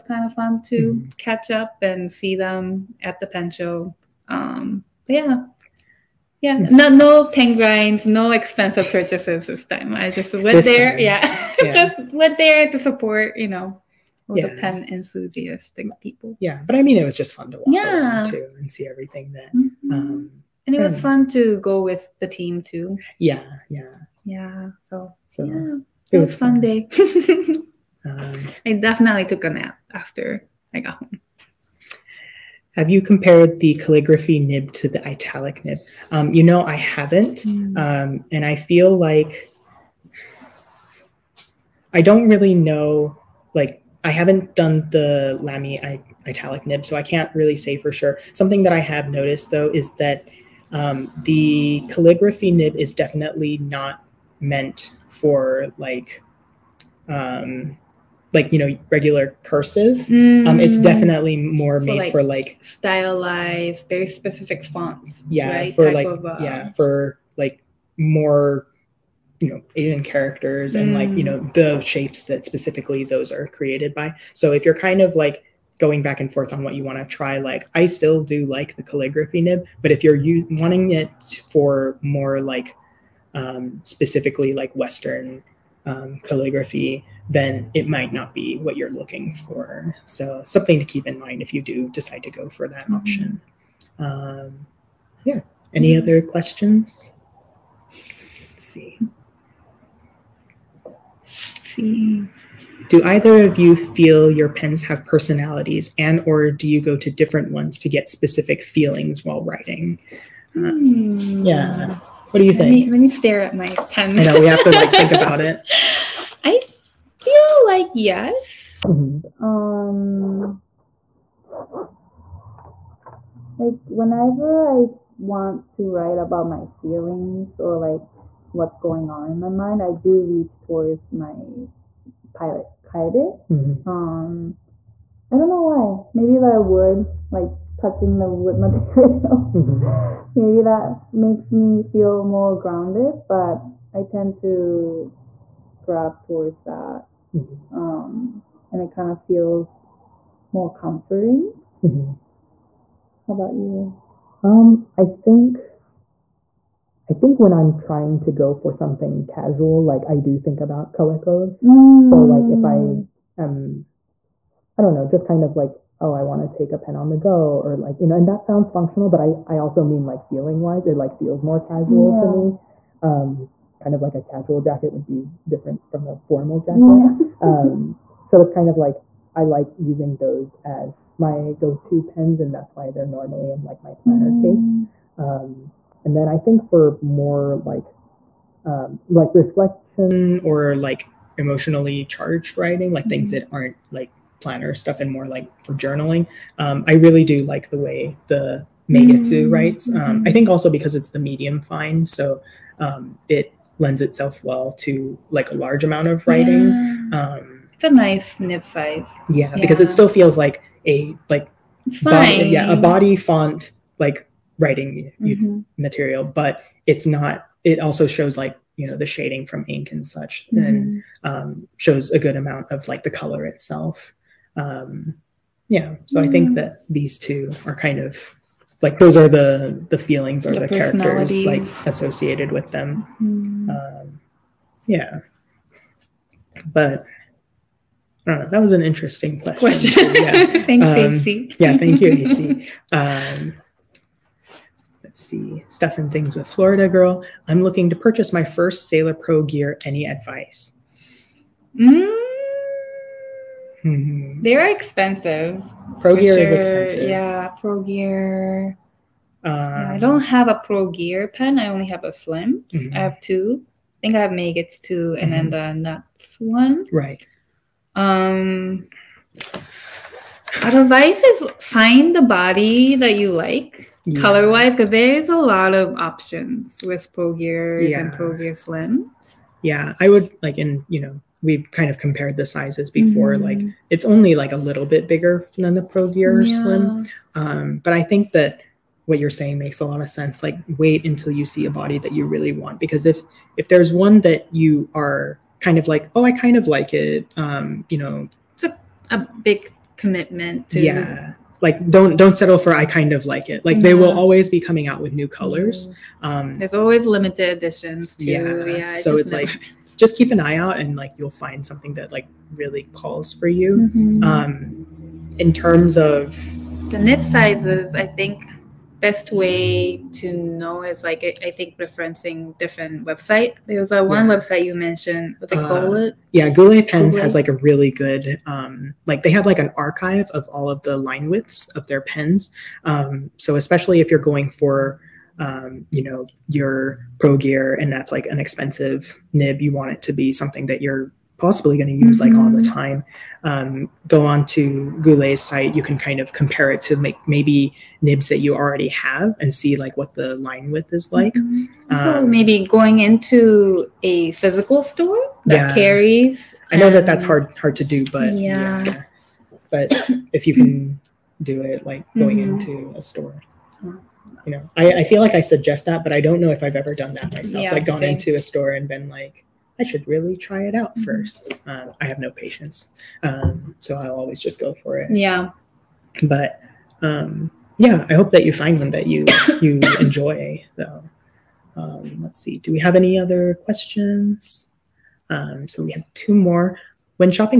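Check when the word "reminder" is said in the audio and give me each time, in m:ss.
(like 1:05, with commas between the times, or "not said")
not said.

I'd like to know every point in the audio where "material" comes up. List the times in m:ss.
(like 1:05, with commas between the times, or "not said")
2:18, 3:35.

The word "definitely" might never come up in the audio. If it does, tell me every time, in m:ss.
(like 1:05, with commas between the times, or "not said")
0:28, 0:52, 1:00.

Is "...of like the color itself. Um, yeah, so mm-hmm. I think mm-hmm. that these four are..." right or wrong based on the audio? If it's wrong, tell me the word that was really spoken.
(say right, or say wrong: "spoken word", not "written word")
wrong: "two", not "four".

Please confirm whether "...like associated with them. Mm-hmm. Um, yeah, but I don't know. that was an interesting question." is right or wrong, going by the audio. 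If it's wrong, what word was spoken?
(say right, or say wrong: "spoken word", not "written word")
right.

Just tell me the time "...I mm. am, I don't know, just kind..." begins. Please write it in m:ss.
2:42.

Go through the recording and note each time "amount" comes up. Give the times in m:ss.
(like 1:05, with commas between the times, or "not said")
3:25, 3:42.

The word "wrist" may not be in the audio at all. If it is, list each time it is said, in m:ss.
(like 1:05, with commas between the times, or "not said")
not said.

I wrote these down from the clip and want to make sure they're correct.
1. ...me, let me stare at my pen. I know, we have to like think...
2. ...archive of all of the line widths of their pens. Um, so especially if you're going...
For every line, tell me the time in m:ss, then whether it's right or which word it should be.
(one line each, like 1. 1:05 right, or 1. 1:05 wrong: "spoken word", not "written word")
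1. 1:52 right
2. 5:29 right.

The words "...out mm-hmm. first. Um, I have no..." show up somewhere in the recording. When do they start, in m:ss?
6:10.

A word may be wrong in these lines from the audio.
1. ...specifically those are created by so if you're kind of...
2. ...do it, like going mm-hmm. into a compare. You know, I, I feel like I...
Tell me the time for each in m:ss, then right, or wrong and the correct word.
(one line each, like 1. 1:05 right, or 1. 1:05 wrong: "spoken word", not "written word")
1. 1:12 right
2. 6:01 wrong: "store", not "compare".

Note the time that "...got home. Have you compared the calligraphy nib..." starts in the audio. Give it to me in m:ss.
0:30.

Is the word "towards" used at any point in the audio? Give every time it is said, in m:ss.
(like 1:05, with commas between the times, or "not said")
2:10, 2:26.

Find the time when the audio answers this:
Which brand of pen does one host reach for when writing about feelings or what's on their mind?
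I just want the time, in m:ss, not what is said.
2:12.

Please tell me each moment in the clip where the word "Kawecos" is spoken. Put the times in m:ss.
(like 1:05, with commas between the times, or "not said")
2:40.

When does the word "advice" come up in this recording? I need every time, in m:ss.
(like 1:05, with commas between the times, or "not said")
4:10, 4:30.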